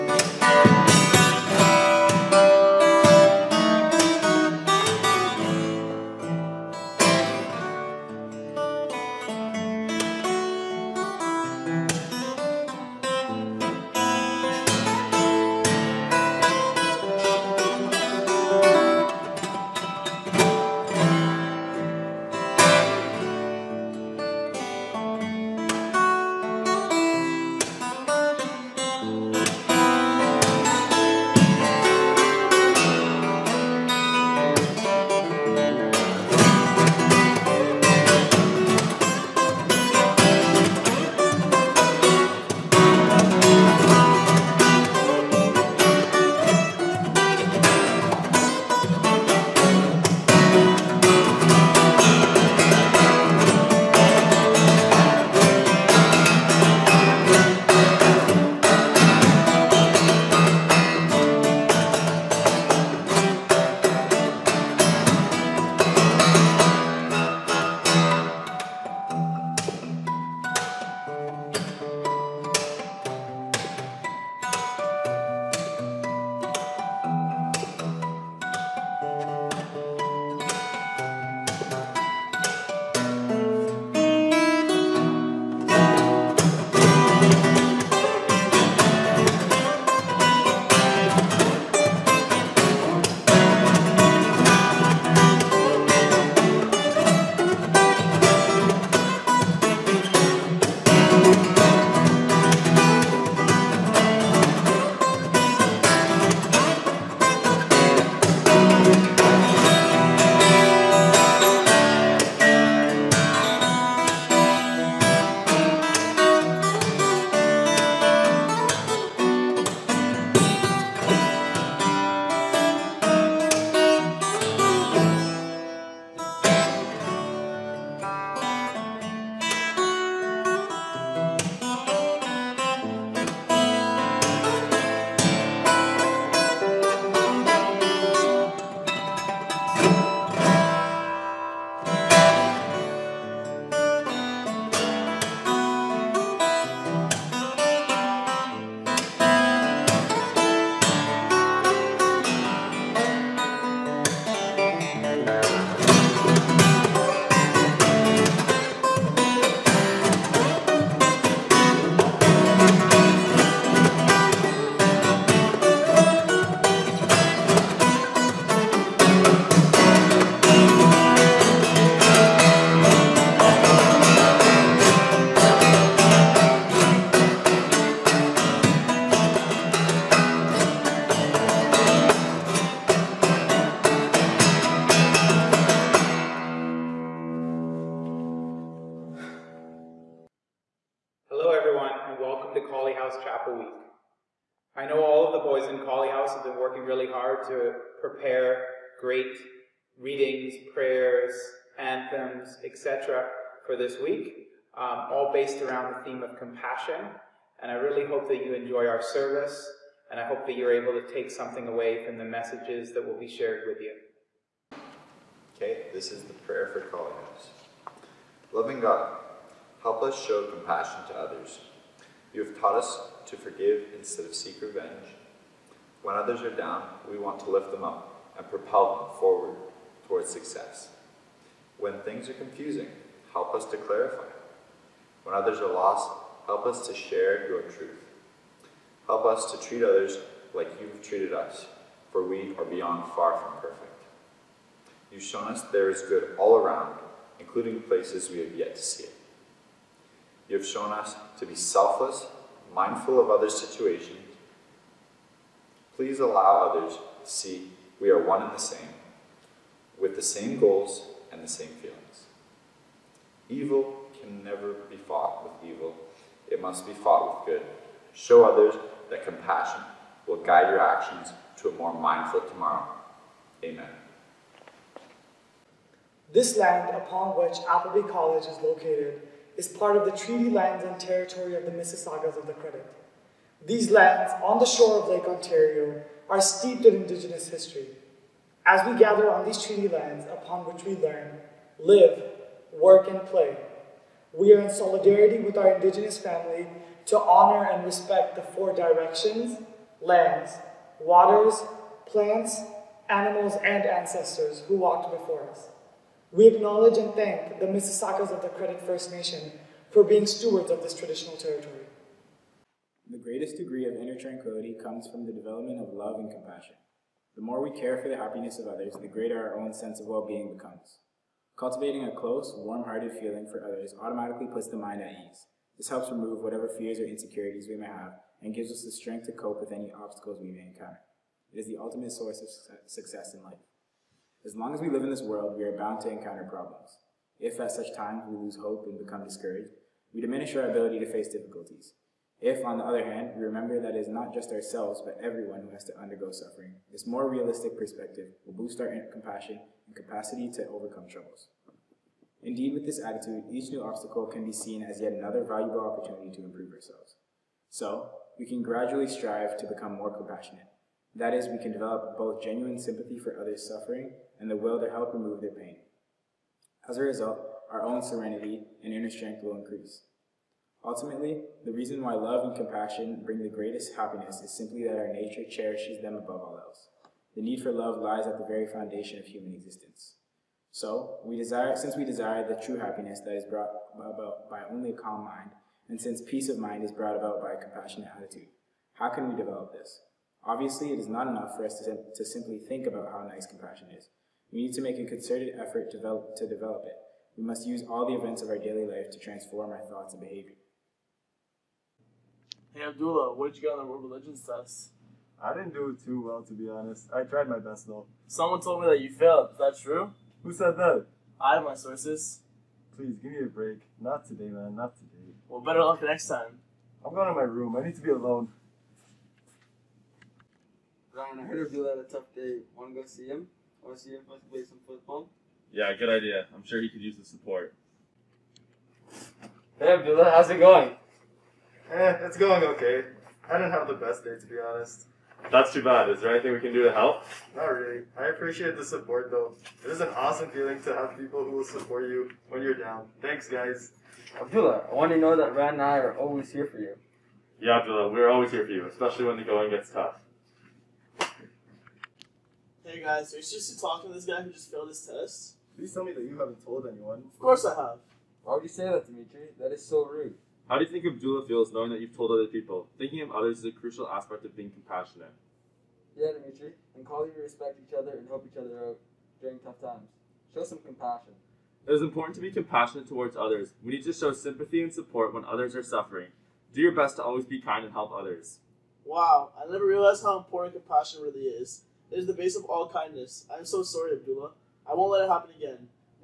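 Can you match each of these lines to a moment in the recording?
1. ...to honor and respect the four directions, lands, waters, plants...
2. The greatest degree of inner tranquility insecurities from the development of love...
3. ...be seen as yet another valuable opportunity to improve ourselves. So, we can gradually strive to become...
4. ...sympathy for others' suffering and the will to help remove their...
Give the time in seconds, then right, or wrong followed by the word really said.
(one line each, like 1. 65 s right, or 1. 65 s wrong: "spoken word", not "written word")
1. 297 s right
2. 313 s wrong: "comes", not "insecurities"
3. 354 s right
4. 362 s right.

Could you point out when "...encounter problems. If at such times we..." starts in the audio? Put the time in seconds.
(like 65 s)
336 s.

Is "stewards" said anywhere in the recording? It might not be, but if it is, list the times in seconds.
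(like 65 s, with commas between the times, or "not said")
310 s.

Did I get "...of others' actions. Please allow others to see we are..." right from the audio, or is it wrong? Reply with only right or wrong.
wrong.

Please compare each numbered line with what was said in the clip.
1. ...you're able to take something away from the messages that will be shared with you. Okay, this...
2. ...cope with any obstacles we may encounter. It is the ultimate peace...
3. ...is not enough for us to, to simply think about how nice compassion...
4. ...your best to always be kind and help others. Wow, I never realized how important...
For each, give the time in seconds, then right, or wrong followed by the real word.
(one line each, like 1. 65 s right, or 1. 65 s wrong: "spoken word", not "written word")
1. 210 s right
2. 329 s wrong: "source", not "peace"
3. 390 s right
4. 476 s right.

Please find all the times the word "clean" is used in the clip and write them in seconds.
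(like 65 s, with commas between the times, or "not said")
not said.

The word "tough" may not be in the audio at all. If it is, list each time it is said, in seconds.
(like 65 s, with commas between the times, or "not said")
422 s, 449 s, 469 s.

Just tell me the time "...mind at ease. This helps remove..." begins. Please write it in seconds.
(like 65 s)
324 s.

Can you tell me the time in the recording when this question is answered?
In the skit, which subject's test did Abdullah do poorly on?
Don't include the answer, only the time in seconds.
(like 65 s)
403 s.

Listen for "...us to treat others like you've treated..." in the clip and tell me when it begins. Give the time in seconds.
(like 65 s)
239 s.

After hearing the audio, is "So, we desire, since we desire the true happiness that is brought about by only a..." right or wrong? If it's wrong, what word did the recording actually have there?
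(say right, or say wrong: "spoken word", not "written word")
right.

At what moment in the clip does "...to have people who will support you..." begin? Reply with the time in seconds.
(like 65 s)
440 s.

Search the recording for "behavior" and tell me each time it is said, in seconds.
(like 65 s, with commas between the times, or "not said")
400 s.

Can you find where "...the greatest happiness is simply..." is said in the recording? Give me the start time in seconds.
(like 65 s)
373 s.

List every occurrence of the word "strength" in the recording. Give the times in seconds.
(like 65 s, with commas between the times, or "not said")
328 s, 369 s.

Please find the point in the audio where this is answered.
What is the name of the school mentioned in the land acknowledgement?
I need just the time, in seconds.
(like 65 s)
277 s.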